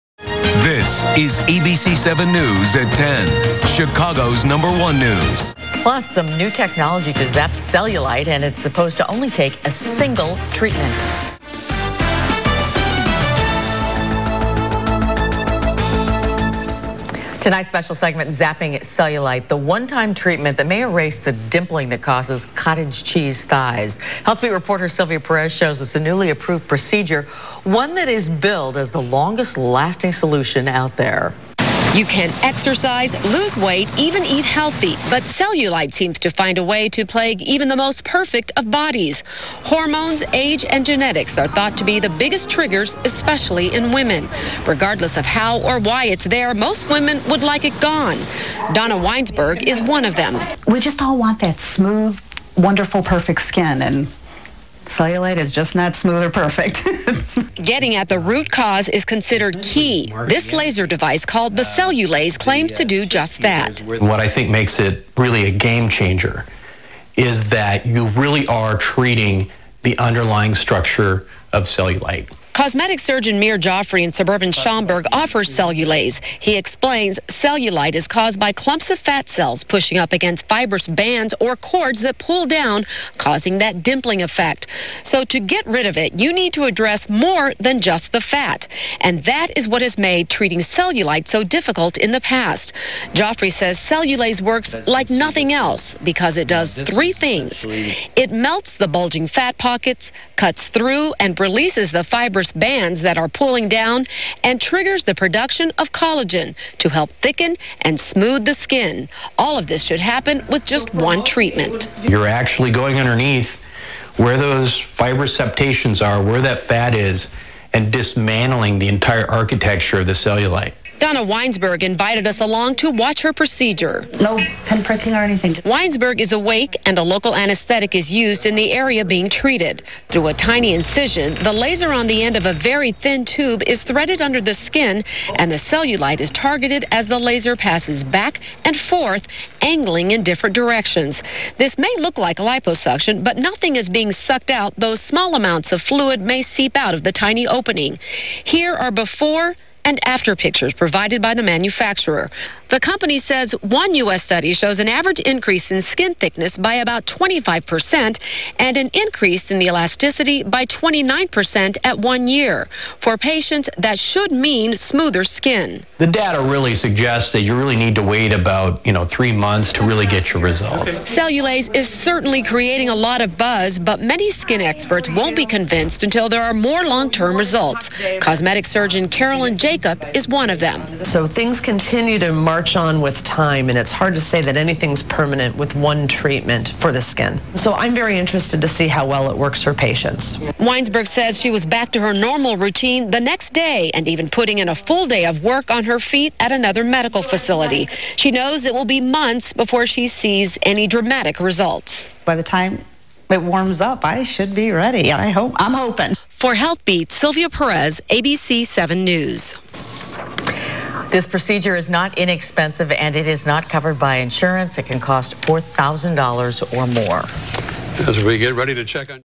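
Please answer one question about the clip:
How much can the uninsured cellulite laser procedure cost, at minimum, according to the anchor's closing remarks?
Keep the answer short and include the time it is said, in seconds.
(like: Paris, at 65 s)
$4,000, at 215 s.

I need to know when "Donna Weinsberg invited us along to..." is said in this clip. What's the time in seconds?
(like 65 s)
121 s.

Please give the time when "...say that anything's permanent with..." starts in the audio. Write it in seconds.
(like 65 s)
184 s.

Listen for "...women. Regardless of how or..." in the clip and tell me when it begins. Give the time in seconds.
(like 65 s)
43 s.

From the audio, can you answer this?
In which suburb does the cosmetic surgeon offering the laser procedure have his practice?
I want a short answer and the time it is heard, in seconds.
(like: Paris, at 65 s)
Schaumburg, at 74 s.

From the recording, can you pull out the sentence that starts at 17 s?
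Tonight's special segment, Zapping Cellulite, the one-time treatment that may erase the dimpling that causes cottage cheese thighs.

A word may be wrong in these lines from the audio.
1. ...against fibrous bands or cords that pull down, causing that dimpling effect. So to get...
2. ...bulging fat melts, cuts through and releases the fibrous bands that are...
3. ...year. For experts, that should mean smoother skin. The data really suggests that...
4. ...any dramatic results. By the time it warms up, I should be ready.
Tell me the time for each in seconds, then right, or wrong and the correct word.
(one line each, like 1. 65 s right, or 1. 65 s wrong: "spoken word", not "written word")
1. 80 s right
2. 98 s wrong: "pockets", not "melts"
3. 162 s wrong: "patients", not "experts"
4. 200 s right.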